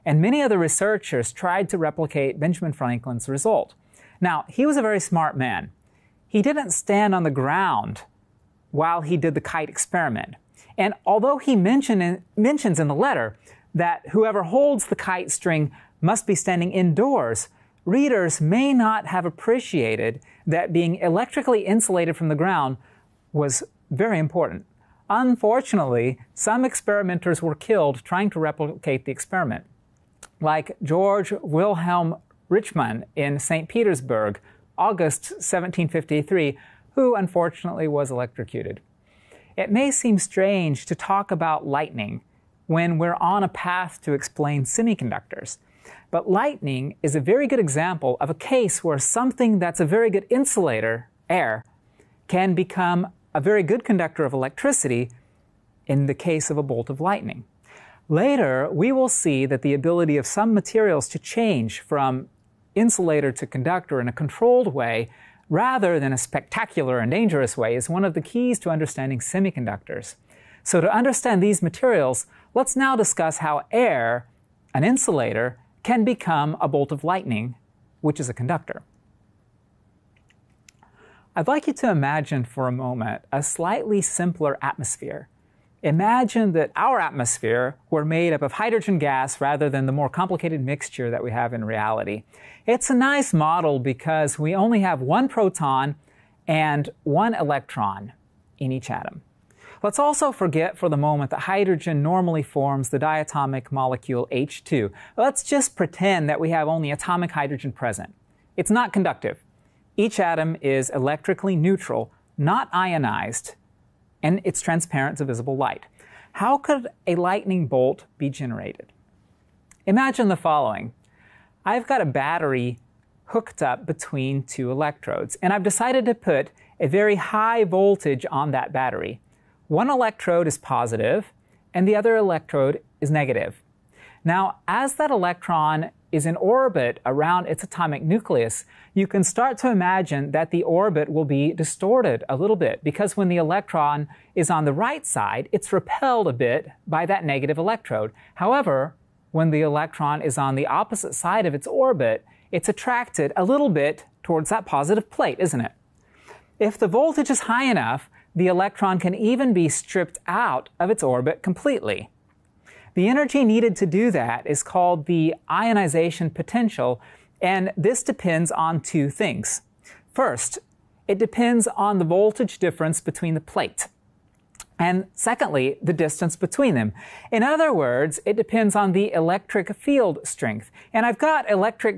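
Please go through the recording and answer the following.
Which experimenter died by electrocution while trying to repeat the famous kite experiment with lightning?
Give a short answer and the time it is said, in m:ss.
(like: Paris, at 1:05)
George Wilhelm Richmann, at 0:30.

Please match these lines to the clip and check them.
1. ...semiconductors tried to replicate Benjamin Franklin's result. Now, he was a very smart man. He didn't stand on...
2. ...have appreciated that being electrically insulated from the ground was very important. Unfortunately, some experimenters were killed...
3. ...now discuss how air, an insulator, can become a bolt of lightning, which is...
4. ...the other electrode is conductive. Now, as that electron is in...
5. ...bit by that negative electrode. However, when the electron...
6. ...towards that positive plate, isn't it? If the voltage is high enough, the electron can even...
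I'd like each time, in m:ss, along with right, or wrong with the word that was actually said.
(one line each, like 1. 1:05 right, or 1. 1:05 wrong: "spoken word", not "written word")
1. 0:00 wrong: "researchers", not "semiconductors"
2. 0:19 right
3. 1:12 right
4. 2:11 wrong: "negative", not "conductive"
5. 2:26 right
6. 2:34 right.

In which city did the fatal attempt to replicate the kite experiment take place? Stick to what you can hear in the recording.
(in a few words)
St. Petersburg.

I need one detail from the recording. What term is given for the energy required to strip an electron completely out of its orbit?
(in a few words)
Ionization potential.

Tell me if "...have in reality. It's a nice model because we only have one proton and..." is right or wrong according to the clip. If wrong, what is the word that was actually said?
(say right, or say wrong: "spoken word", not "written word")
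right.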